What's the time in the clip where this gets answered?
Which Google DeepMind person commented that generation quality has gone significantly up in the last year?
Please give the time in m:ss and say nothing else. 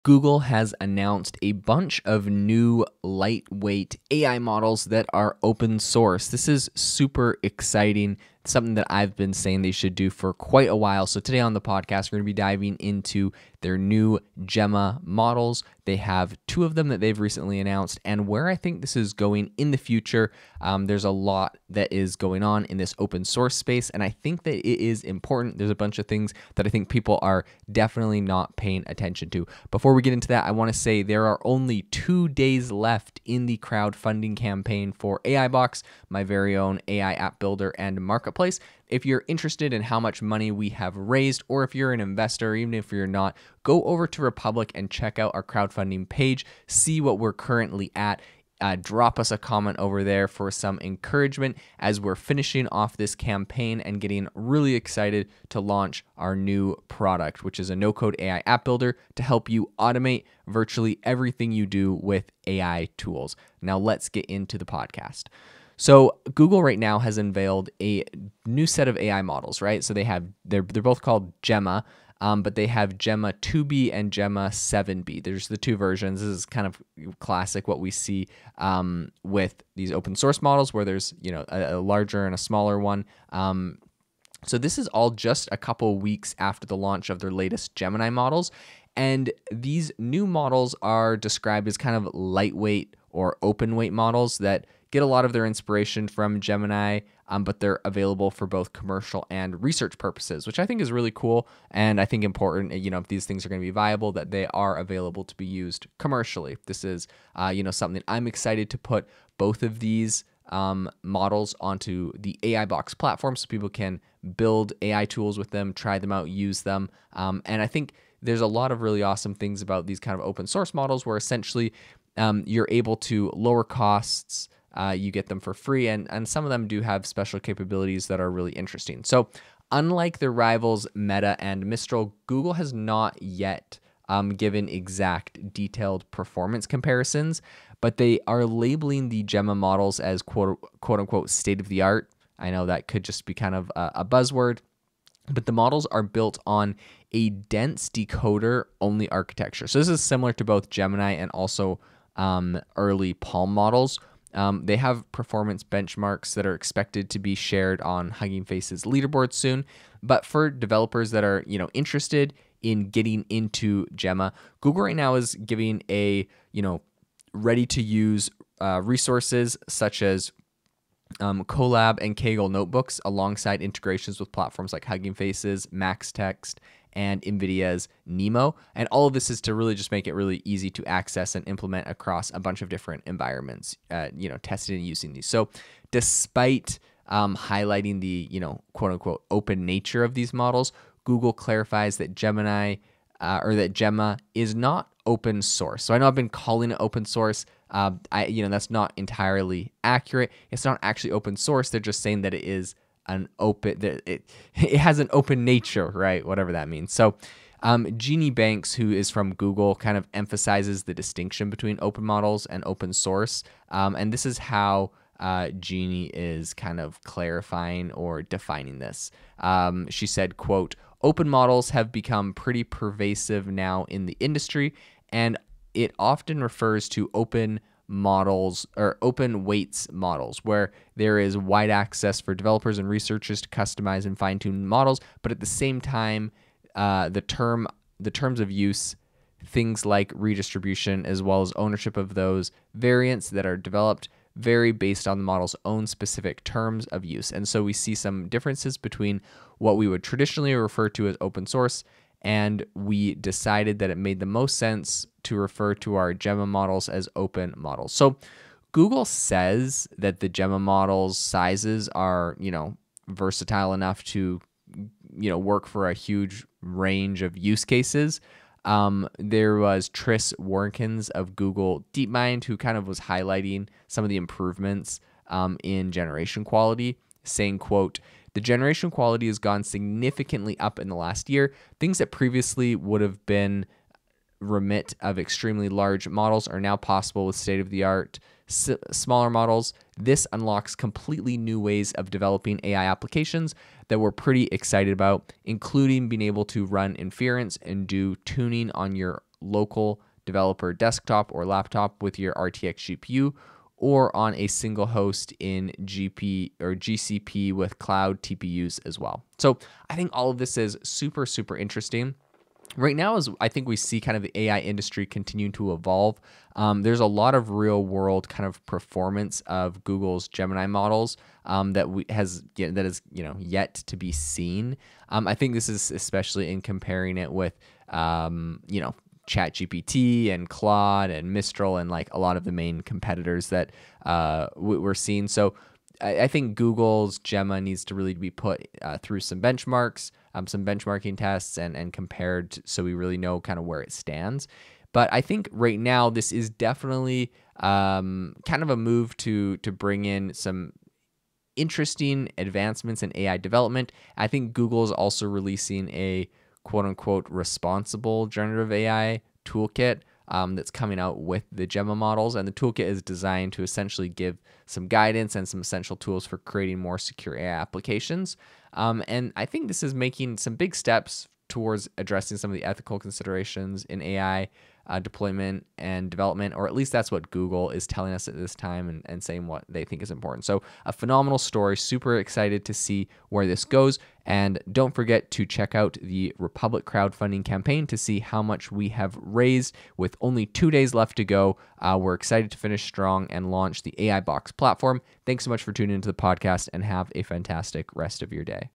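4:29.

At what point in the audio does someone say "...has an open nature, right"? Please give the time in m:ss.
3:24.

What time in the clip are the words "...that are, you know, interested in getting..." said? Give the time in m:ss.
2:41.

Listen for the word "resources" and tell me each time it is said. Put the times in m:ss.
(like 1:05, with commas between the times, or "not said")
2:48.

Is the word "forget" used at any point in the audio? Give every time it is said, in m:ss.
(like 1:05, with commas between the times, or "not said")
6:24.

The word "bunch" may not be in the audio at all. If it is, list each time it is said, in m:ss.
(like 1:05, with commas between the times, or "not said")
0:01, 0:25, 3:02.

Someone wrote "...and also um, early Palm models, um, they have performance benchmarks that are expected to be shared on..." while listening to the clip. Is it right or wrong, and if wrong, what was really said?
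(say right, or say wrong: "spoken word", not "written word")
right.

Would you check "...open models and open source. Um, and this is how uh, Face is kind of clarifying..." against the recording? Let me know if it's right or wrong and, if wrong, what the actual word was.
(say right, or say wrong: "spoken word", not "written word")
wrong: "Jeannie", not "Face".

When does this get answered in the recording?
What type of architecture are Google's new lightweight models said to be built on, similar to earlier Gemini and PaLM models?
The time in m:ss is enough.
2:27.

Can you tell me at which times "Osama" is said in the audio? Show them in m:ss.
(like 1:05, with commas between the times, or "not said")
not said.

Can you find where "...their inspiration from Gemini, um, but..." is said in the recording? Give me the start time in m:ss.
1:35.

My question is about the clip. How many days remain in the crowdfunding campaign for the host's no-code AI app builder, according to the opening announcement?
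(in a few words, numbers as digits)
2.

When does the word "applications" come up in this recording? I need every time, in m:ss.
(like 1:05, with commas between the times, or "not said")
4:52, 6:07.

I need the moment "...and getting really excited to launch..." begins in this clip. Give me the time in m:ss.
0:53.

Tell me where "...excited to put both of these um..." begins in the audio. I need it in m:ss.
1:48.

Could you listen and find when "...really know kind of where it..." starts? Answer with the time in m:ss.
5:42.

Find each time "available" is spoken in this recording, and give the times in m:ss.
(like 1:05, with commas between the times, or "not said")
1:37, 1:44.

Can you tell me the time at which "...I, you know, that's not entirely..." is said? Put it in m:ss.
3:18.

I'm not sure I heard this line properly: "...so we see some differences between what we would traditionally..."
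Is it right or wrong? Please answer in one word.
right.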